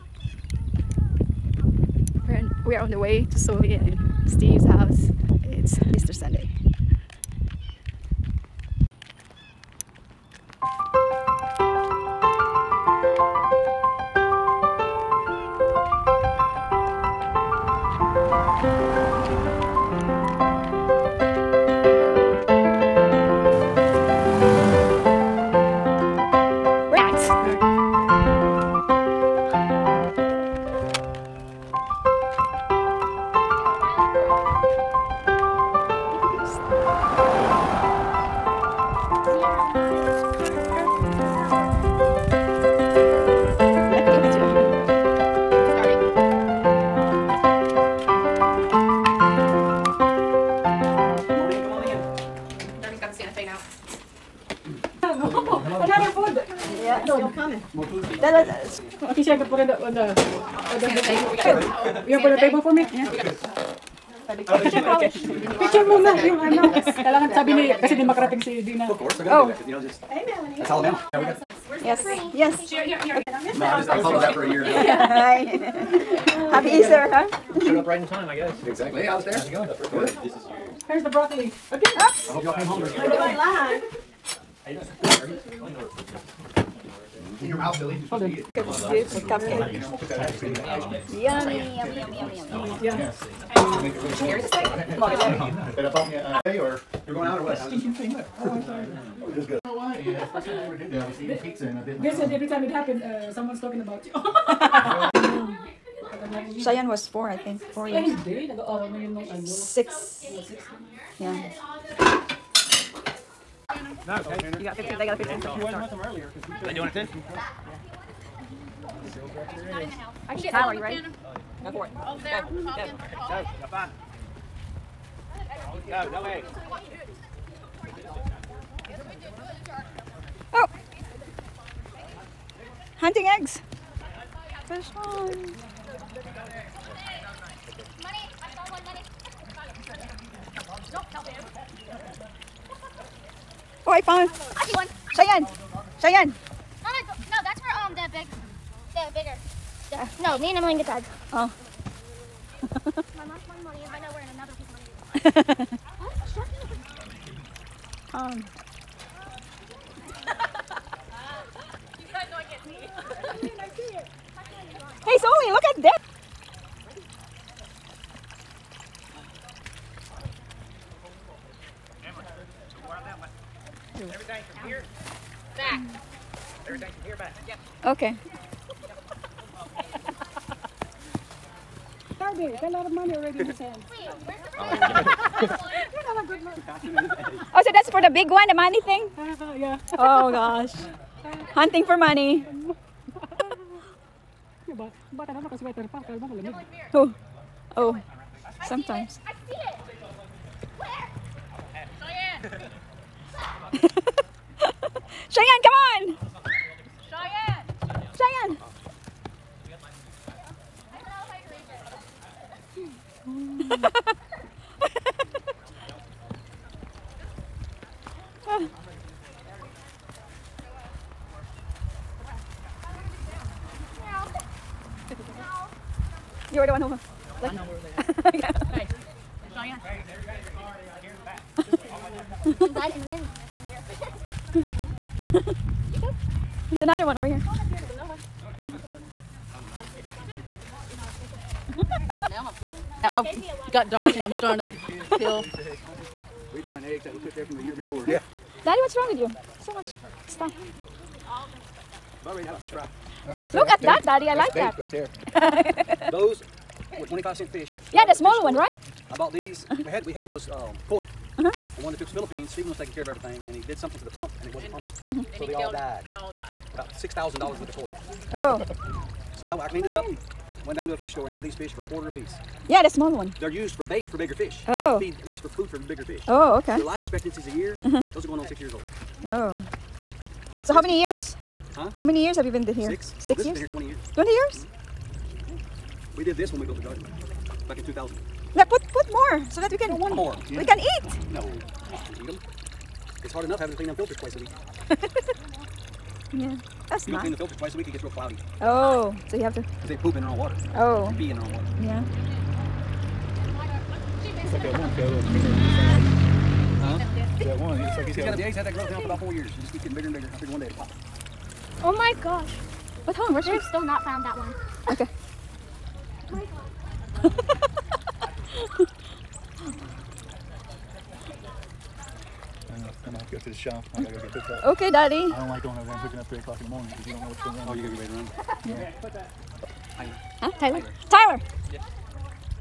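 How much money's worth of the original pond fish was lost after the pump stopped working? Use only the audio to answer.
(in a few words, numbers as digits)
$6,000.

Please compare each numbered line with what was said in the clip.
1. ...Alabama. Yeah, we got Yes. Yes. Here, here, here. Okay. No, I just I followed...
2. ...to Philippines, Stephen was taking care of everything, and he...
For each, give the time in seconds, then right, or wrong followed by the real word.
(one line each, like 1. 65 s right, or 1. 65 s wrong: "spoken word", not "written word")
1. 70 s right
2. 262 s right.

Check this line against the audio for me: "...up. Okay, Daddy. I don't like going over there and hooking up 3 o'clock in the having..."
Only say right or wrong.
wrong.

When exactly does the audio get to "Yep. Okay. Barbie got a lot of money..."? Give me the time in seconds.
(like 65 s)
177 s.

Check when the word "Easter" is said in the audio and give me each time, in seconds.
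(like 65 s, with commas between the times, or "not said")
5 s, 76 s.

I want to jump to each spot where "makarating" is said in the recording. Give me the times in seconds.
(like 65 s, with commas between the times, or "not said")
68 s.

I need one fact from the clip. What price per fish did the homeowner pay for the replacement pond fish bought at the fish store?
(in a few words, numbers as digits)
a quarter.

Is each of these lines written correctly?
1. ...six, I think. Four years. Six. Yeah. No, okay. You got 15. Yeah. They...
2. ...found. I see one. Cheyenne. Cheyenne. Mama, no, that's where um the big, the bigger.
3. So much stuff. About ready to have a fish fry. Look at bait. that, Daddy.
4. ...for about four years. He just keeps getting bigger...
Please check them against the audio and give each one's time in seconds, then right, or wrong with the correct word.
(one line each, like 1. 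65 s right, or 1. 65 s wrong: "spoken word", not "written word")
1. 107 s wrong: "four", not "six"
2. 144 s right
3. 249 s right
4. 309 s right.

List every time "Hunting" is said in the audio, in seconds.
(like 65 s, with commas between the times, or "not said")
133 s, 191 s.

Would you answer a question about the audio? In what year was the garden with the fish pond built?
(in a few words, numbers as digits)
2000.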